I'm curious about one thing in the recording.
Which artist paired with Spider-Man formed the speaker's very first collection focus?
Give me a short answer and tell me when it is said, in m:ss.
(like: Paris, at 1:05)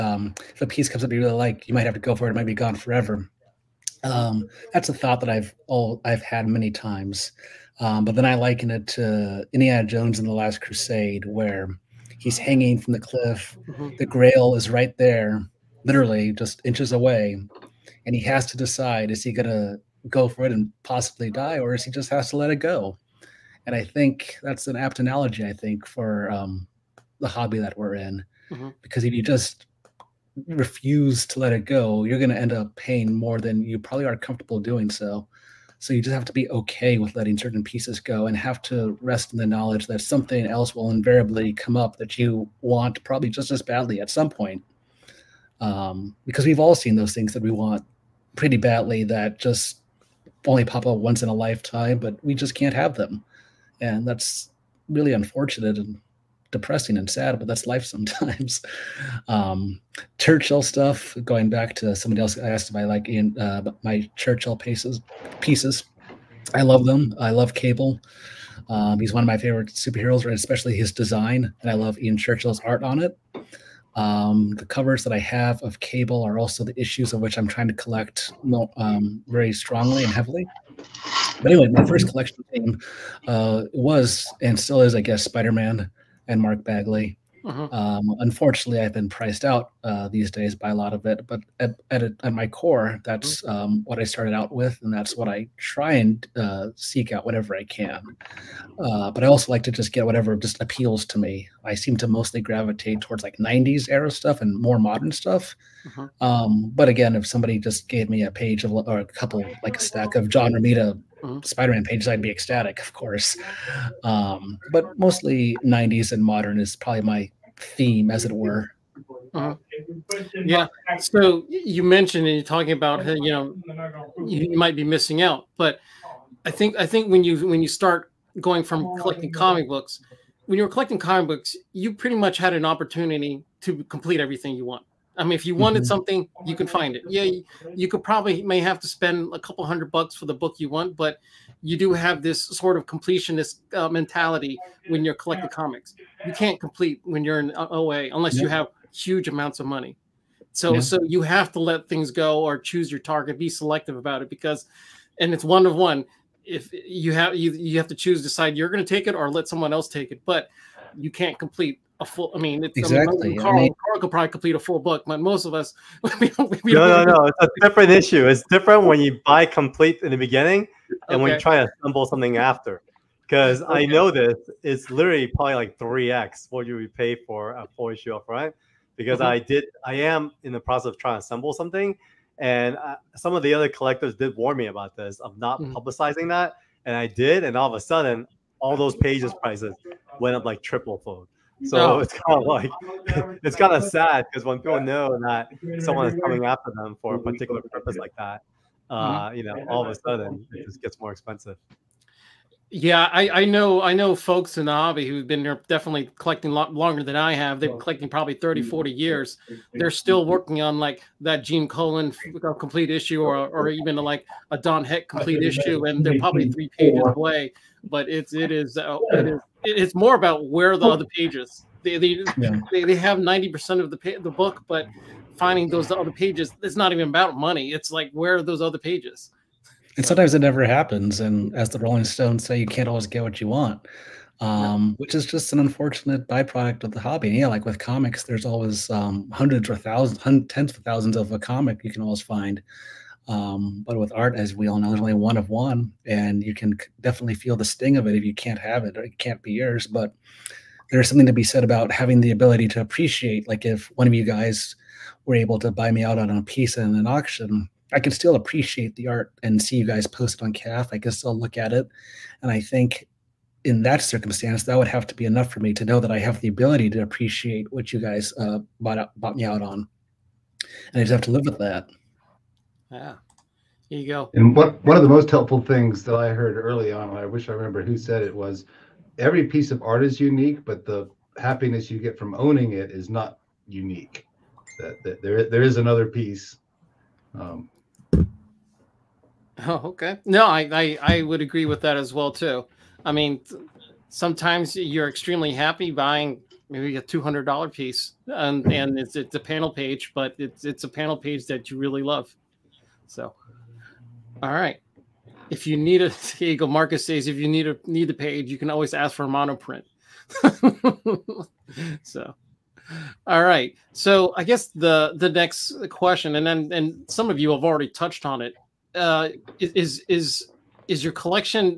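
Mark Bagley, at 1:26.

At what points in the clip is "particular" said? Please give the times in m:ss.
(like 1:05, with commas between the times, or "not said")
3:17.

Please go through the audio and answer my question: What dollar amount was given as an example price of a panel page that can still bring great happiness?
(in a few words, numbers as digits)
$200.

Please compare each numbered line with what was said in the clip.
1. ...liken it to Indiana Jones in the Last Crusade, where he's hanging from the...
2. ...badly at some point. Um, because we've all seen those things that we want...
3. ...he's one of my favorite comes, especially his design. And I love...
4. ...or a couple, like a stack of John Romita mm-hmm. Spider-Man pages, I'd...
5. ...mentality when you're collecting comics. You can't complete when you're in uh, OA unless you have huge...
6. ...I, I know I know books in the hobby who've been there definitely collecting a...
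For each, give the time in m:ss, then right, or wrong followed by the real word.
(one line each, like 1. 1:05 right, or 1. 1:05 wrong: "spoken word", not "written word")
1. 0:08 right
2. 0:43 right
3. 1:08 wrong: "superheroes", not "comes"
4. 1:48 right
5. 2:23 right
6. 3:23 wrong: "folks", not "books".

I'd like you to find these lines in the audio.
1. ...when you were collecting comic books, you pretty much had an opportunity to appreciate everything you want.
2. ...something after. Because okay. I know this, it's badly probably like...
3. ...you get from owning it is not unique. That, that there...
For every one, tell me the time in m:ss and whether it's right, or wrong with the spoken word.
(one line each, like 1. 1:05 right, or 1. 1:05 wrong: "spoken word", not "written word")
1. 2:10 wrong: "complete", not "appreciate"
2. 2:52 wrong: "literally", not "badly"
3. 4:41 right.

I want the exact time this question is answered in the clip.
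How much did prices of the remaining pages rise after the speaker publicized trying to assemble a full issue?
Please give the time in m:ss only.
3:10.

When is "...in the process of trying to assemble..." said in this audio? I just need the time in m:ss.
3:00.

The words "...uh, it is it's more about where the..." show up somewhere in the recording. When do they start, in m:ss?
3:38.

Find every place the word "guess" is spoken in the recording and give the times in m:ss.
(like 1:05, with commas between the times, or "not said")
1:25, 5:14.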